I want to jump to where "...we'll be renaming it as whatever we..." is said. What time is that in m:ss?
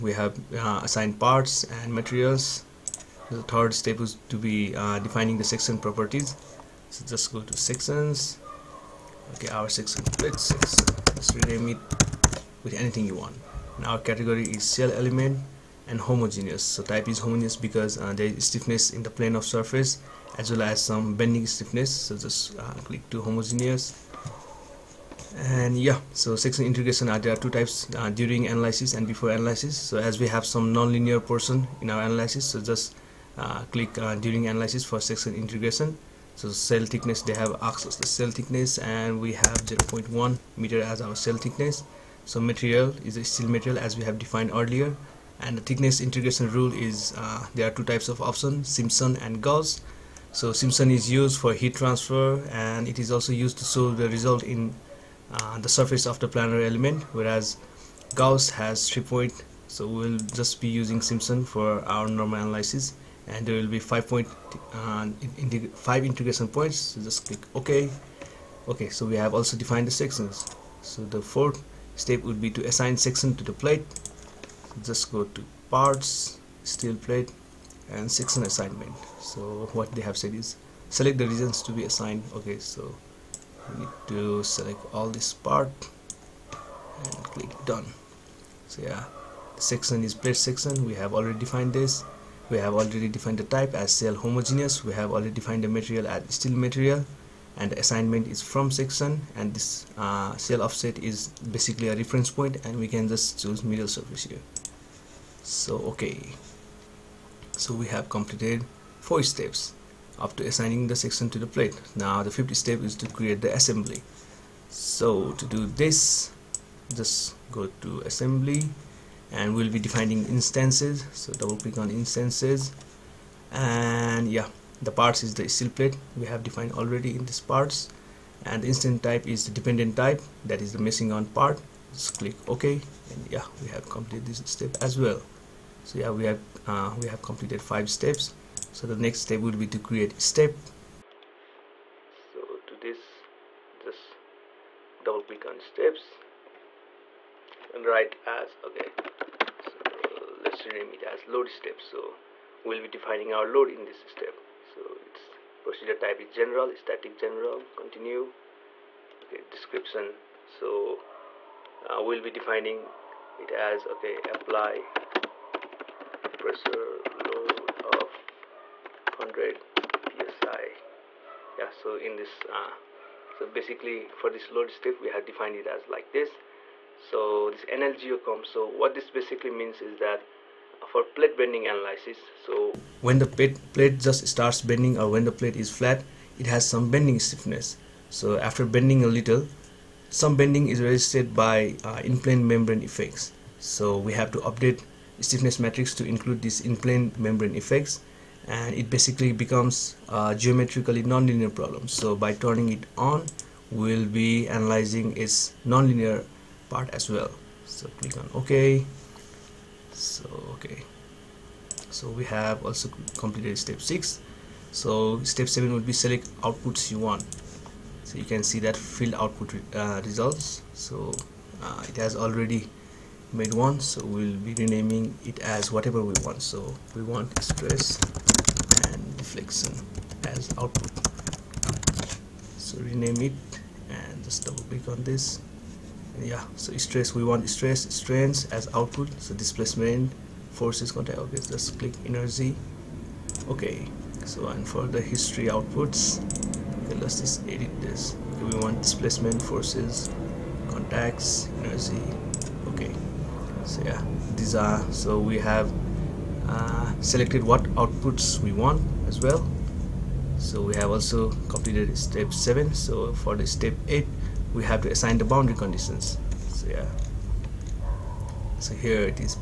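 3:44.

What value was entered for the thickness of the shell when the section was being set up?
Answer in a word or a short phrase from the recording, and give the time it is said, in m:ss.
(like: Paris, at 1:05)
0.1 meter, at 0:39.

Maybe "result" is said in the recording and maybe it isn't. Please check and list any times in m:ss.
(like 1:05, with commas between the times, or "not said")
0:54, 3:40.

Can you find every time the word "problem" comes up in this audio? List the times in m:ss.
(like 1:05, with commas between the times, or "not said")
3:21.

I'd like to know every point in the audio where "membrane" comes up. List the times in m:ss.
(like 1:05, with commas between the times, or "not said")
3:12, 3:17.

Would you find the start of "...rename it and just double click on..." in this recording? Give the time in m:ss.
3:52.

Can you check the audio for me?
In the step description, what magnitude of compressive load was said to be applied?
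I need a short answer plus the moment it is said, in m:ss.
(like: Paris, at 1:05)
100 psi, at 2:49.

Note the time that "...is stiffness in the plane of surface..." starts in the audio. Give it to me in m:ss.
0:18.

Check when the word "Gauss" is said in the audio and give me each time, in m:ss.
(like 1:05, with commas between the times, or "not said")
0:49, 0:58.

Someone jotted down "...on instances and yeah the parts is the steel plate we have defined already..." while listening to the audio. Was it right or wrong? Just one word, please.
right.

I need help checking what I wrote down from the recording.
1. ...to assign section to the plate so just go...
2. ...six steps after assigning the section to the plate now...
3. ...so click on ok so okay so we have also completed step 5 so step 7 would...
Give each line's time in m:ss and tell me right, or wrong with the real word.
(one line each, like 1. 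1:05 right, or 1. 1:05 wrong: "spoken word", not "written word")
1. 1:12 right
2. 1:48 wrong: "four", not "six"
3. 3:27 wrong: "6", not "5".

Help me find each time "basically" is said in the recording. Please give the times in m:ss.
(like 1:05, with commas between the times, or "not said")
1:41, 2:53, 2:59, 3:18.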